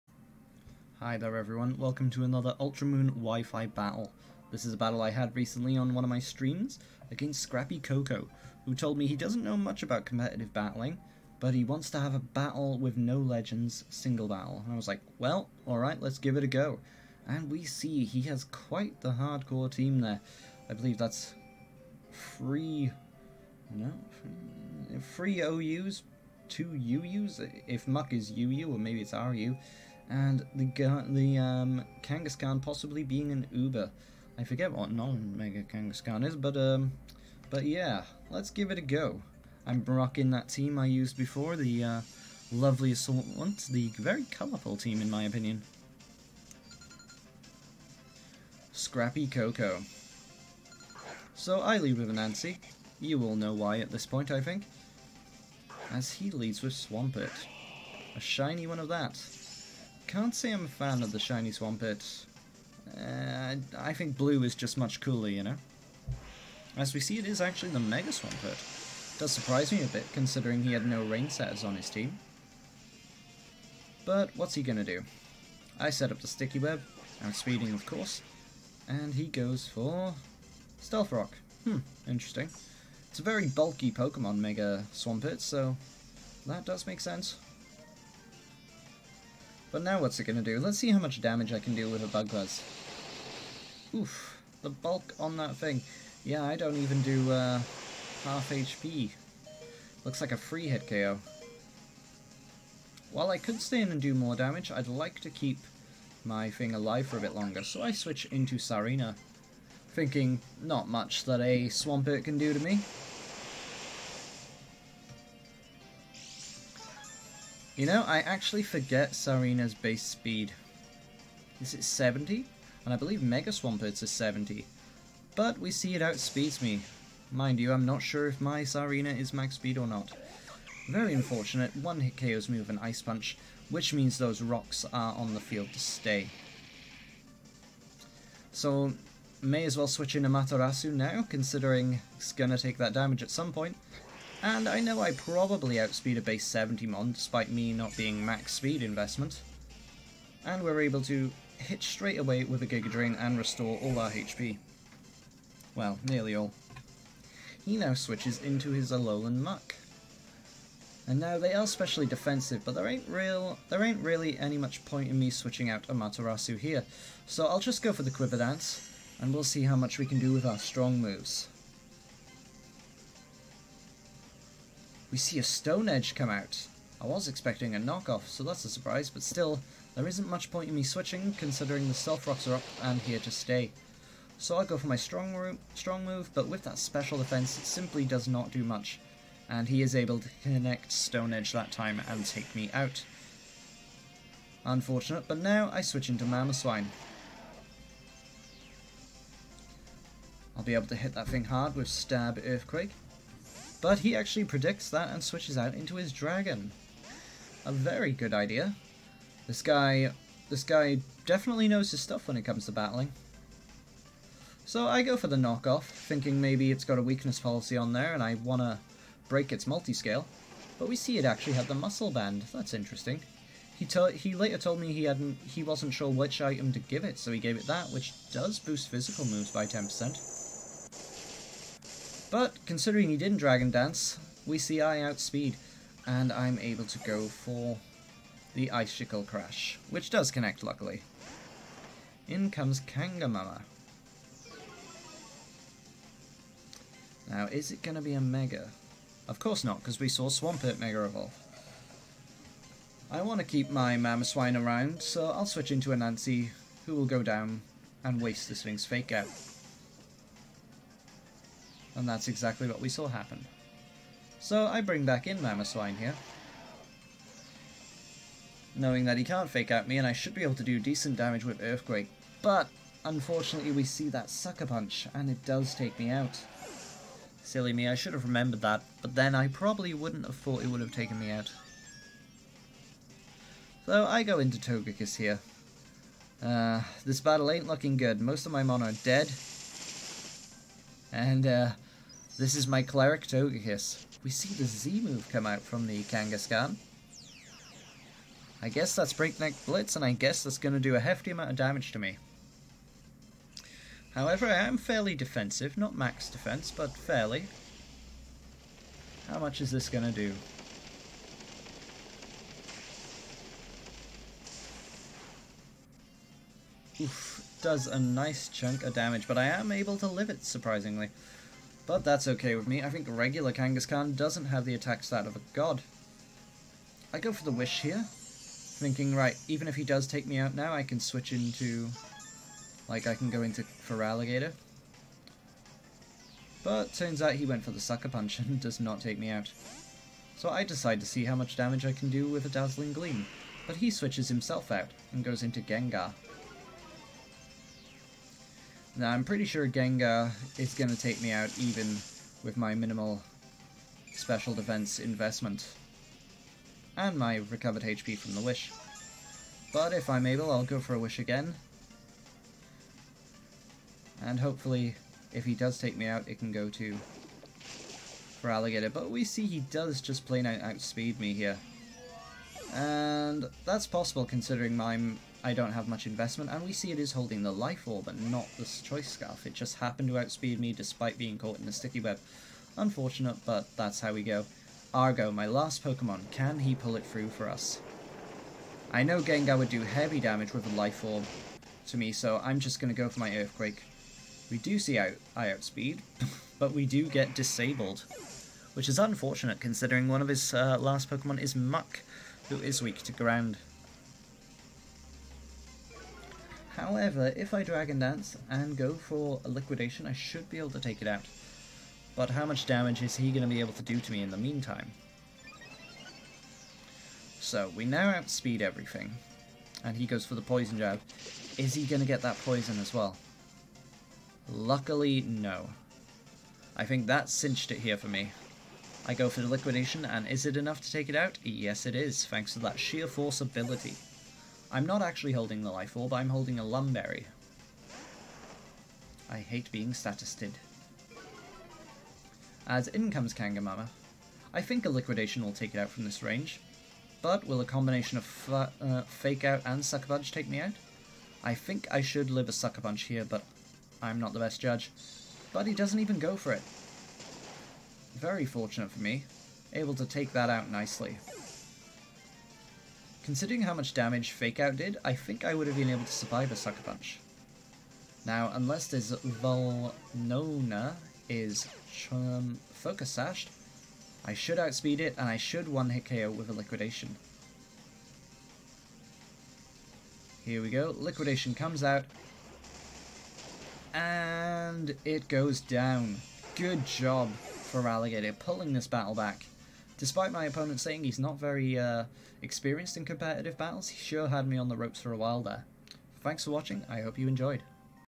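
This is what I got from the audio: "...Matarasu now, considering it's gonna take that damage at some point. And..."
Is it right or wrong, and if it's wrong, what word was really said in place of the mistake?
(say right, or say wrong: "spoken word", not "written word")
right.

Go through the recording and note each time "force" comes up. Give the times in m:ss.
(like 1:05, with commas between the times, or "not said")
7:13.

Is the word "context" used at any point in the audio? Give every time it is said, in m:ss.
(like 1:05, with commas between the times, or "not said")
not said.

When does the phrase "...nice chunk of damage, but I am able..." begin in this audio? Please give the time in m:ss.
5:17.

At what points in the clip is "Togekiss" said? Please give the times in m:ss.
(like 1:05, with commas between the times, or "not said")
4:44, 4:53.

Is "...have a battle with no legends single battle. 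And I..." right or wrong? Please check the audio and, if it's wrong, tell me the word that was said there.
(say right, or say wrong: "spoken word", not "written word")
right.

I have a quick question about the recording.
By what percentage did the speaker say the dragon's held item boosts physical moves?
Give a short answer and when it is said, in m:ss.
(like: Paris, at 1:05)
10%, at 3:49.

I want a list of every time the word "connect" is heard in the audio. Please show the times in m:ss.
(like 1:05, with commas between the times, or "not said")
3:10, 4:00.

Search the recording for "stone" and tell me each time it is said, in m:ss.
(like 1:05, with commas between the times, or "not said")
2:55, 3:10.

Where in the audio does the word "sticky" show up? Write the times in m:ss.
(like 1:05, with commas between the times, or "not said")
1:16, 6:21.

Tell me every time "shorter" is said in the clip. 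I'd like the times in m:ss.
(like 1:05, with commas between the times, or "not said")
not said.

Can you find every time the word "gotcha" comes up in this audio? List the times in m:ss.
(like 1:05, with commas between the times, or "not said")
not said.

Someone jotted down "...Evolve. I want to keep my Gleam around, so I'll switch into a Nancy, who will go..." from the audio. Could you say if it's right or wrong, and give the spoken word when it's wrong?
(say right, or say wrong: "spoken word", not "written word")
wrong: "Mamoswine", not "Gleam".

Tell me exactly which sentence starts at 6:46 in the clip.
However, if I Dragon Dance and go for a Liquidation, I should be able to take it out.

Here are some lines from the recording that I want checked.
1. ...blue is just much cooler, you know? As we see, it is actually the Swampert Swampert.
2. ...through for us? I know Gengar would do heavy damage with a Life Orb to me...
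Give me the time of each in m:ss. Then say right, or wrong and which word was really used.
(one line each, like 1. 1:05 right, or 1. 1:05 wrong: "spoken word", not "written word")
1. 1:04 wrong: "Mega", not "Swampert"
2. 6:27 right.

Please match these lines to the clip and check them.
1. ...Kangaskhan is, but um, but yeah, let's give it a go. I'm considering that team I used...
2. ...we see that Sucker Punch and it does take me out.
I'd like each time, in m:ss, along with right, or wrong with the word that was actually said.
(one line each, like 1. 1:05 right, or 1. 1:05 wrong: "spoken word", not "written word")
1. 0:35 wrong: "rocking", not "considering"
2. 4:33 right.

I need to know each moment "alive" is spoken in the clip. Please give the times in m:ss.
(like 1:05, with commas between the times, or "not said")
1:46.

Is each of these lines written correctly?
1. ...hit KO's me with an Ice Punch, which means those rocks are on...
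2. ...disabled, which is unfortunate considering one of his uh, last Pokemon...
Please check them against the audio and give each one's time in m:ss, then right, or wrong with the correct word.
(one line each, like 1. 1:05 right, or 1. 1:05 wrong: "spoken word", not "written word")
1. 2:12 right
2. 6:37 right.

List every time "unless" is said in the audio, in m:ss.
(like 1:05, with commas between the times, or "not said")
7:48.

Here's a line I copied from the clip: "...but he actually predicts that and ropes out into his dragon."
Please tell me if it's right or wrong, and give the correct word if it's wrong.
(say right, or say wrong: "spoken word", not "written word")
wrong: "switches", not "ropes".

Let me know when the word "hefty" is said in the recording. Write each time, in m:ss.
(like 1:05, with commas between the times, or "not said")
5:00.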